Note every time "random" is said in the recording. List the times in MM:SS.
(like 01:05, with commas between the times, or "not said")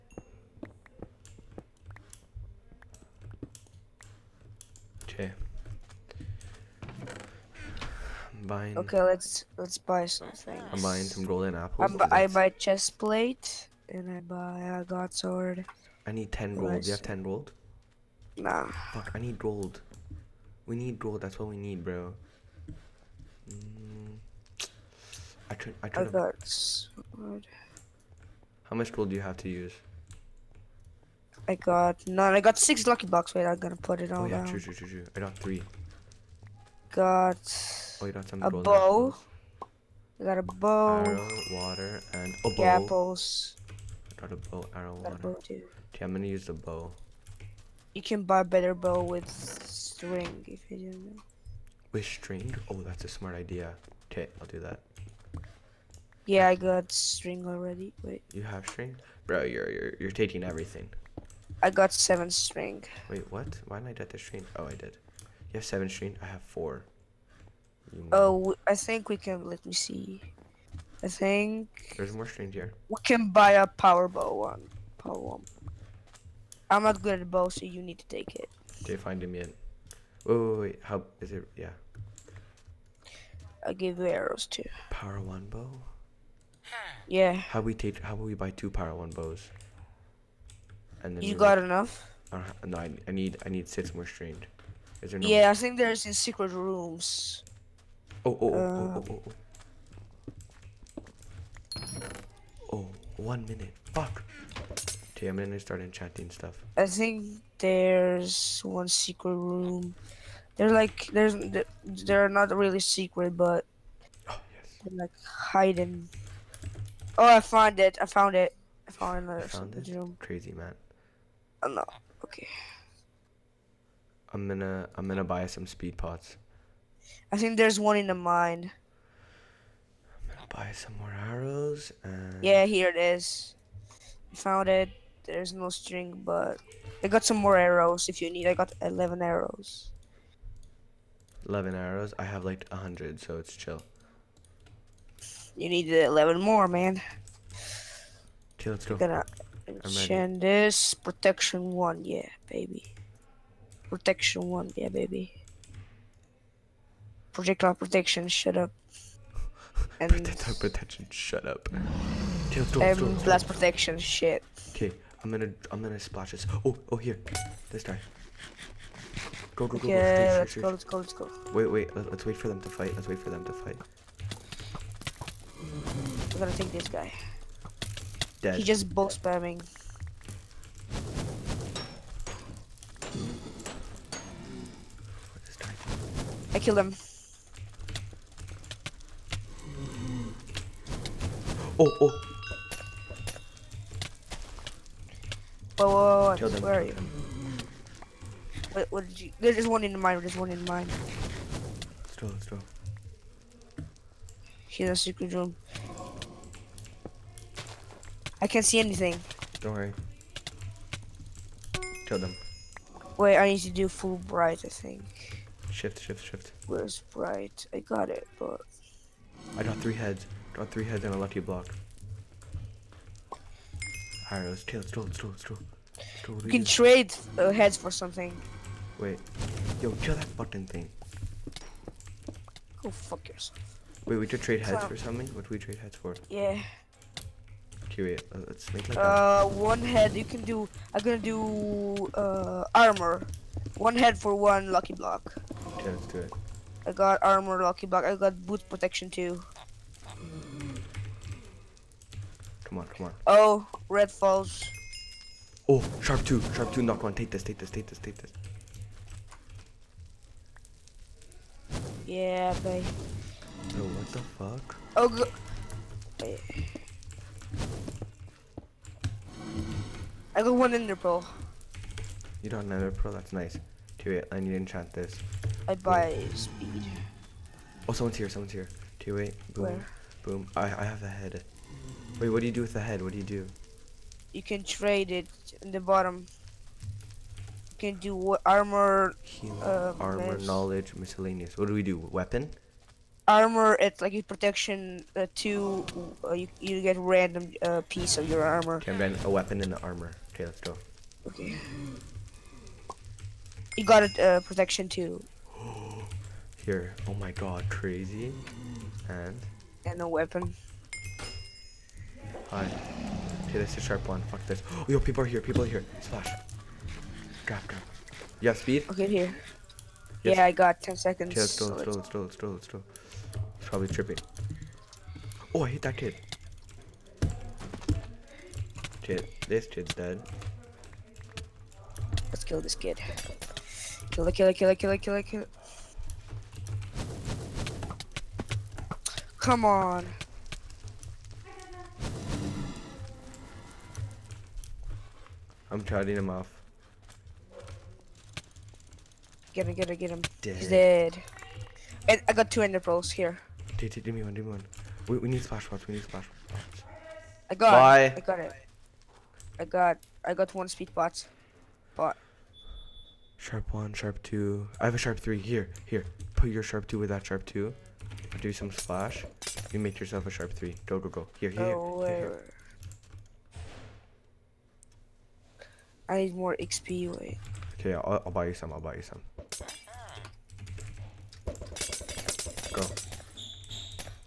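04:56.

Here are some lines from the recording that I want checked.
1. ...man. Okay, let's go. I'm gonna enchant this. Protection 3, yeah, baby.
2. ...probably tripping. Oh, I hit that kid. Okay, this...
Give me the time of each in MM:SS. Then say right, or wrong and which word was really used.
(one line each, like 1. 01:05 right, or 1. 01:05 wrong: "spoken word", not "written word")
1. 02:26 wrong: "1", not "3"
2. 05:23 right.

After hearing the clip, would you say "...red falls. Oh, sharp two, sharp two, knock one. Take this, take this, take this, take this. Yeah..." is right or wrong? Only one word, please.
right.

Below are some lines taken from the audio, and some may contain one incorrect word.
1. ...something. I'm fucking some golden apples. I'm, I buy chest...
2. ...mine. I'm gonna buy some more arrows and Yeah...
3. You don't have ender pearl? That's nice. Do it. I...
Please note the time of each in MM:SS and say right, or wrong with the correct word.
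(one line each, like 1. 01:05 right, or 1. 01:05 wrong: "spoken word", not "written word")
1. 00:10 wrong: "buying", not "fucking"
2. 02:08 right
3. 04:32 right.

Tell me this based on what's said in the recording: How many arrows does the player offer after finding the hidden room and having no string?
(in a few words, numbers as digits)
11.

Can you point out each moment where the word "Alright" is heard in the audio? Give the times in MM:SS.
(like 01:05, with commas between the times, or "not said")
03:44, 05:12.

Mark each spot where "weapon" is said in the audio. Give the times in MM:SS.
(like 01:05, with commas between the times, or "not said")
04:51, 04:59, 05:10.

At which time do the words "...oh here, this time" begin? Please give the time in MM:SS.
02:46.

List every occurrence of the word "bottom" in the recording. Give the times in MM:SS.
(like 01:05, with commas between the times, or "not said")
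04:45.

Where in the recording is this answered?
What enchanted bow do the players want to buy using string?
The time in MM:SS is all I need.
01:13.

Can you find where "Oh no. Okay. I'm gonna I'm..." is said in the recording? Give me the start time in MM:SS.
02:01.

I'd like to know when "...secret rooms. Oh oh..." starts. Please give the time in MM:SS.
01:36.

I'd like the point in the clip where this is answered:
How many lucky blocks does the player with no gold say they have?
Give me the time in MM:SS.
00:32.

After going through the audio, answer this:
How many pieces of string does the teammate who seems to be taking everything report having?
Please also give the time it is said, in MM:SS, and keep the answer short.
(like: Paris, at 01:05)
7, at 01:01.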